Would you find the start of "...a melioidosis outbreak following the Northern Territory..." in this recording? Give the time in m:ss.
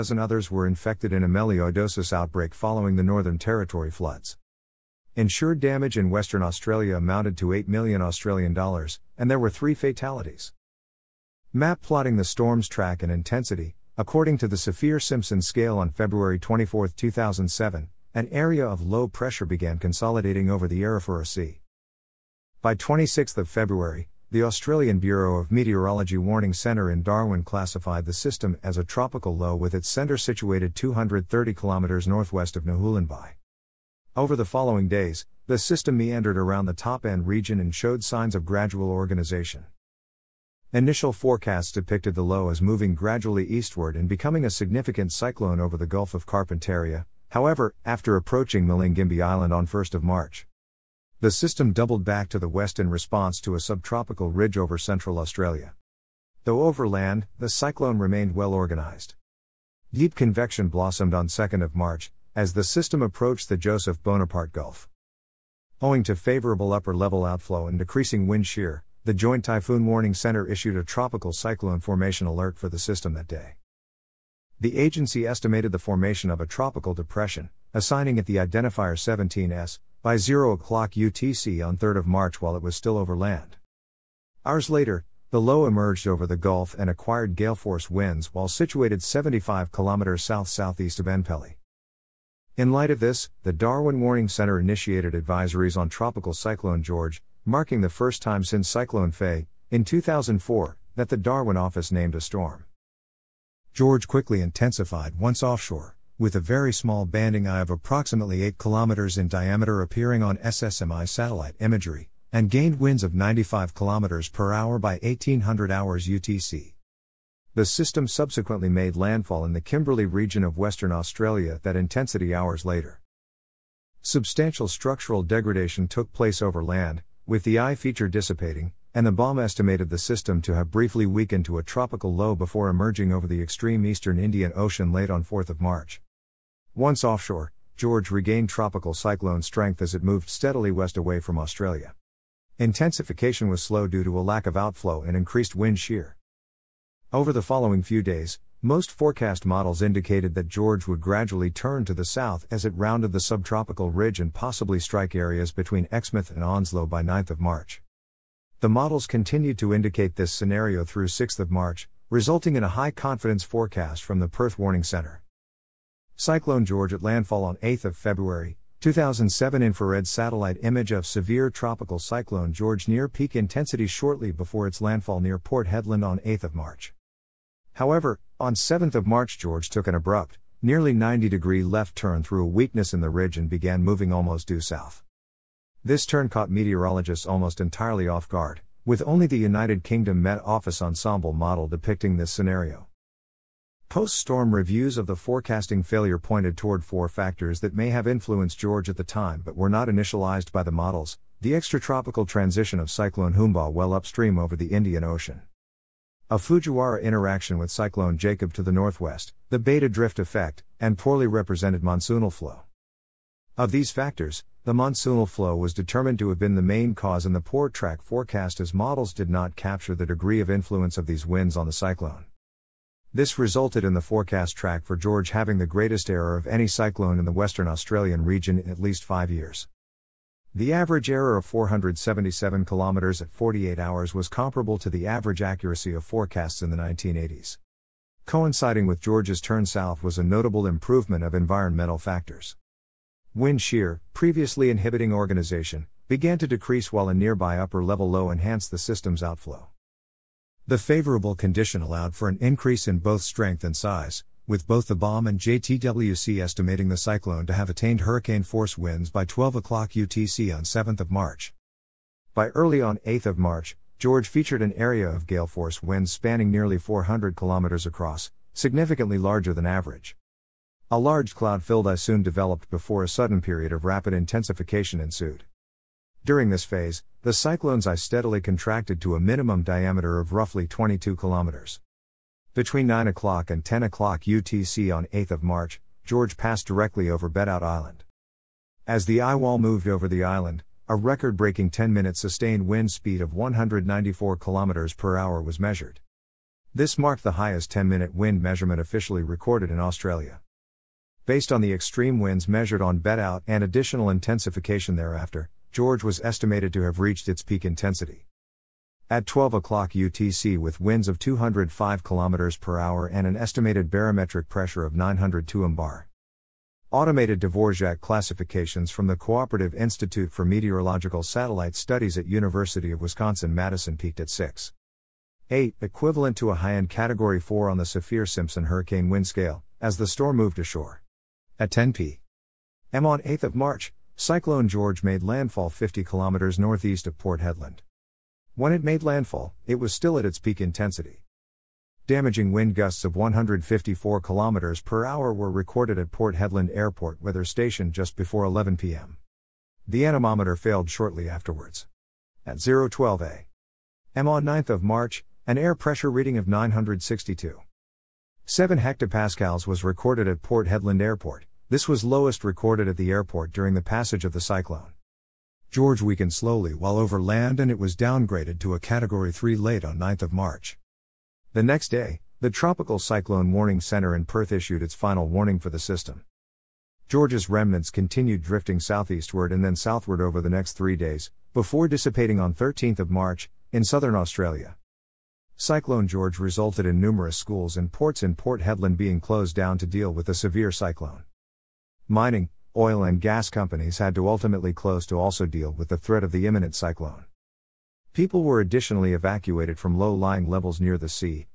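0:01.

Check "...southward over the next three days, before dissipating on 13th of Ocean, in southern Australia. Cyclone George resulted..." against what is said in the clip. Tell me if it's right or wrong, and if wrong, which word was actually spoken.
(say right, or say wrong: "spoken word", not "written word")
wrong: "March", not "Ocean".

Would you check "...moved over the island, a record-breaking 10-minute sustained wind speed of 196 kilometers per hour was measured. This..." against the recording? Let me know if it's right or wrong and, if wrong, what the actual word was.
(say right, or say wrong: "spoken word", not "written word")
wrong: "194", not "196".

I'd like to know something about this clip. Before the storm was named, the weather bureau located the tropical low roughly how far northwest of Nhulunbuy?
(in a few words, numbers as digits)
230 km.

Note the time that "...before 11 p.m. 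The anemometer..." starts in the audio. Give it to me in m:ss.
5:48.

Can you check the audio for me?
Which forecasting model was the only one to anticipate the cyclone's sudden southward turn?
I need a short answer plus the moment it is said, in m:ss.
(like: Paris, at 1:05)
United Kingdom Met Office ensemble, at 3:09.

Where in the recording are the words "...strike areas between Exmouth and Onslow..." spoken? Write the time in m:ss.
2:34.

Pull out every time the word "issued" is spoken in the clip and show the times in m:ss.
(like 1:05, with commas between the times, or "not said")
1:10, 6:14.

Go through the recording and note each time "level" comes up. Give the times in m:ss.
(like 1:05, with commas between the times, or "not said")
1:06, 4:07, 6:40.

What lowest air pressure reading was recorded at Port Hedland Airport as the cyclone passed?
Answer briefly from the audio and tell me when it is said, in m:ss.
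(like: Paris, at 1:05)
962.7 hectopascals, at 5:56.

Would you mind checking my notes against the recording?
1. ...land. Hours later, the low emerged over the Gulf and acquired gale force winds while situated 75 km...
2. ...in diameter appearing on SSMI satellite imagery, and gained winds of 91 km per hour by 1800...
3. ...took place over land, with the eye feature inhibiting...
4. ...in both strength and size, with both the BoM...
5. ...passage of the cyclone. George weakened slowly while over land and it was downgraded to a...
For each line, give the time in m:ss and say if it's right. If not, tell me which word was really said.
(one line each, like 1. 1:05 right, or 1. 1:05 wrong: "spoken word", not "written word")
1. 1:23 right
2. 1:49 wrong: "95", not "91"
3. 2:05 wrong: "dissipating", not "inhibiting"
4. 4:12 right
5. 6:03 right.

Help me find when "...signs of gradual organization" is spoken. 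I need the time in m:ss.
0:38.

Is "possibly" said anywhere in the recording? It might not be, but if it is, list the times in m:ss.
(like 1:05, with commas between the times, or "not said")
2:34.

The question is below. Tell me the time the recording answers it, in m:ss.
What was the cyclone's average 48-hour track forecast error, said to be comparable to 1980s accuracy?
3:51.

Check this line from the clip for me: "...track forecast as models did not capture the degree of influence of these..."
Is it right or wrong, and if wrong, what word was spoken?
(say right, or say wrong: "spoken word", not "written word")
right.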